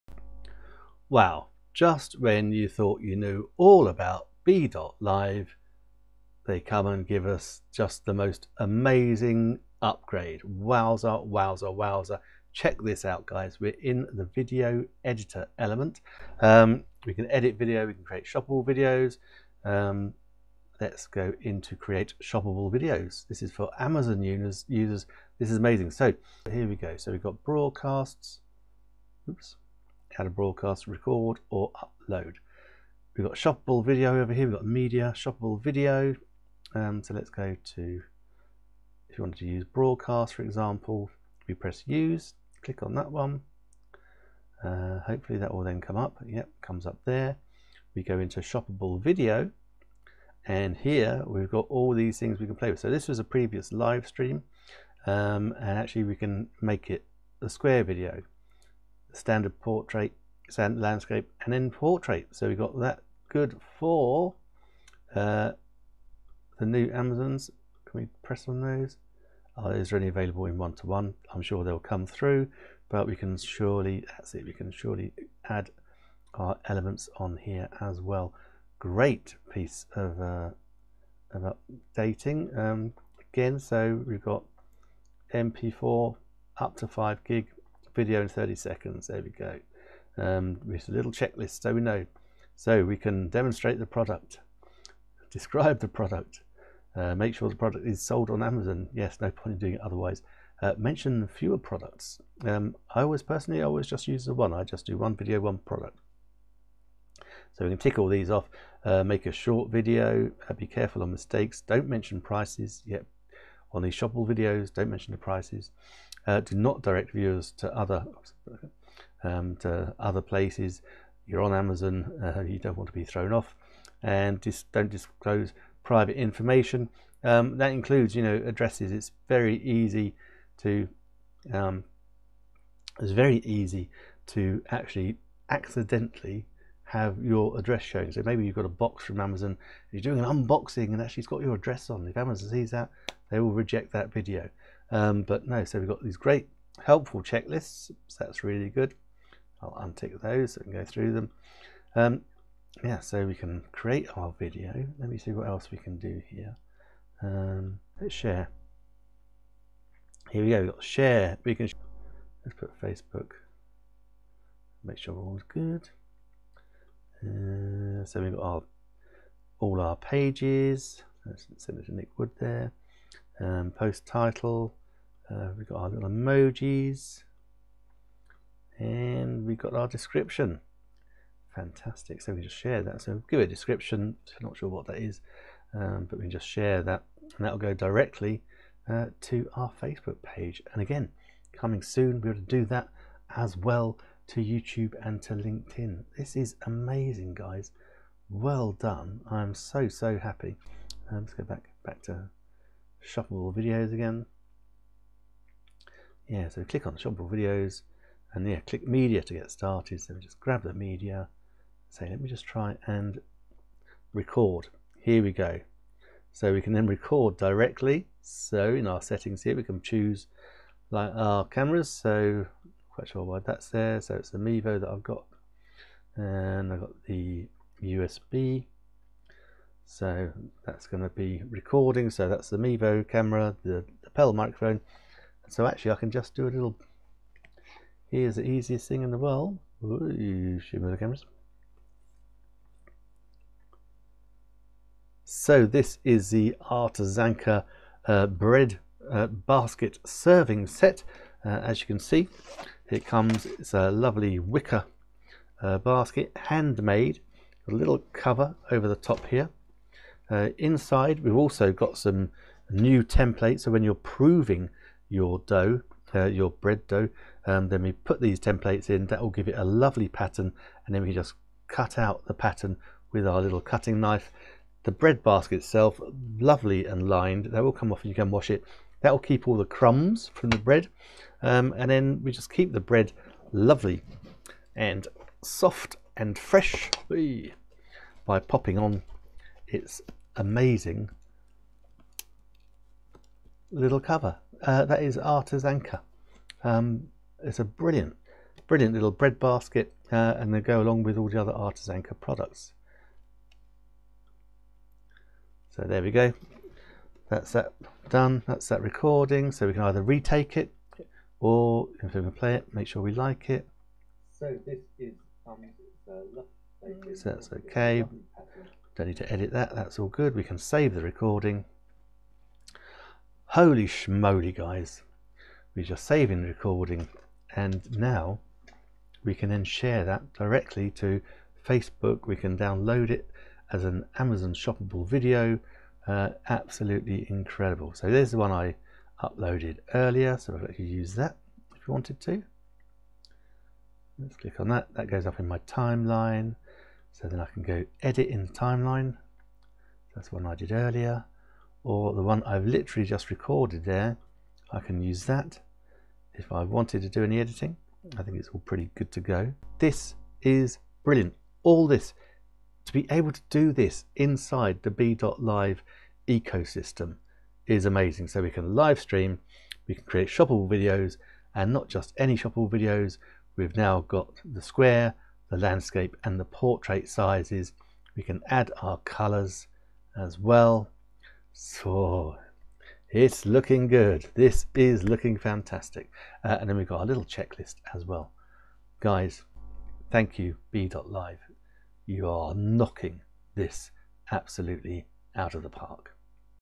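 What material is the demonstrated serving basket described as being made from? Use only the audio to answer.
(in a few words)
wicker.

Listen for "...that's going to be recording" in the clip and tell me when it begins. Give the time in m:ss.
3:50.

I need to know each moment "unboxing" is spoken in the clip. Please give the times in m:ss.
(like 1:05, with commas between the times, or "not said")
2:20.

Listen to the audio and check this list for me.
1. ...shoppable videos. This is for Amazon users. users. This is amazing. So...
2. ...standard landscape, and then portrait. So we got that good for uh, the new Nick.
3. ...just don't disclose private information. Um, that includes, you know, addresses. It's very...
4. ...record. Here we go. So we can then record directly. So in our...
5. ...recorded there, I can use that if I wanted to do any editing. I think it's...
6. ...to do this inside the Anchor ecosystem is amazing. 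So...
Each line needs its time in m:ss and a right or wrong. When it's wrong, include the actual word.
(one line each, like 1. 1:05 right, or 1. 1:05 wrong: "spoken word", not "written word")
1. 0:22 right
2. 1:00 wrong: "Amazons", not "Nick"
3. 2:04 right
4. 3:34 right
5. 5:53 right
6. 6:03 wrong: "BeLive", not "Anchor".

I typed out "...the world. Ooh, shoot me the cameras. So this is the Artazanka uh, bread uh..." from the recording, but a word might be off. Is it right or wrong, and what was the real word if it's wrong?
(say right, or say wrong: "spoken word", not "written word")
right.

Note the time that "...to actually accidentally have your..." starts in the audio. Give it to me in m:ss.
2:14.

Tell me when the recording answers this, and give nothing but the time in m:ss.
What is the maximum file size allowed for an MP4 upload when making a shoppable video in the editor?
1:26.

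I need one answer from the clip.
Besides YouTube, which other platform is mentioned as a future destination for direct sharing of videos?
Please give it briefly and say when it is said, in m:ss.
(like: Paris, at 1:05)
LinkedIn, at 3:15.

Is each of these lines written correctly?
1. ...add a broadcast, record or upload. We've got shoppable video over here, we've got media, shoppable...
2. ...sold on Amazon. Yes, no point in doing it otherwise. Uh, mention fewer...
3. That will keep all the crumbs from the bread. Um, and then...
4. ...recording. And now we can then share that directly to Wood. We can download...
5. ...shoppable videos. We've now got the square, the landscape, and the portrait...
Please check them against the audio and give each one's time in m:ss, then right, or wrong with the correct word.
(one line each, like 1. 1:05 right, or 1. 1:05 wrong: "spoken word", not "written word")
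1. 0:30 right
2. 1:38 right
3. 4:39 right
4. 5:26 wrong: "Facebook", not "Wood"
5. 6:12 right.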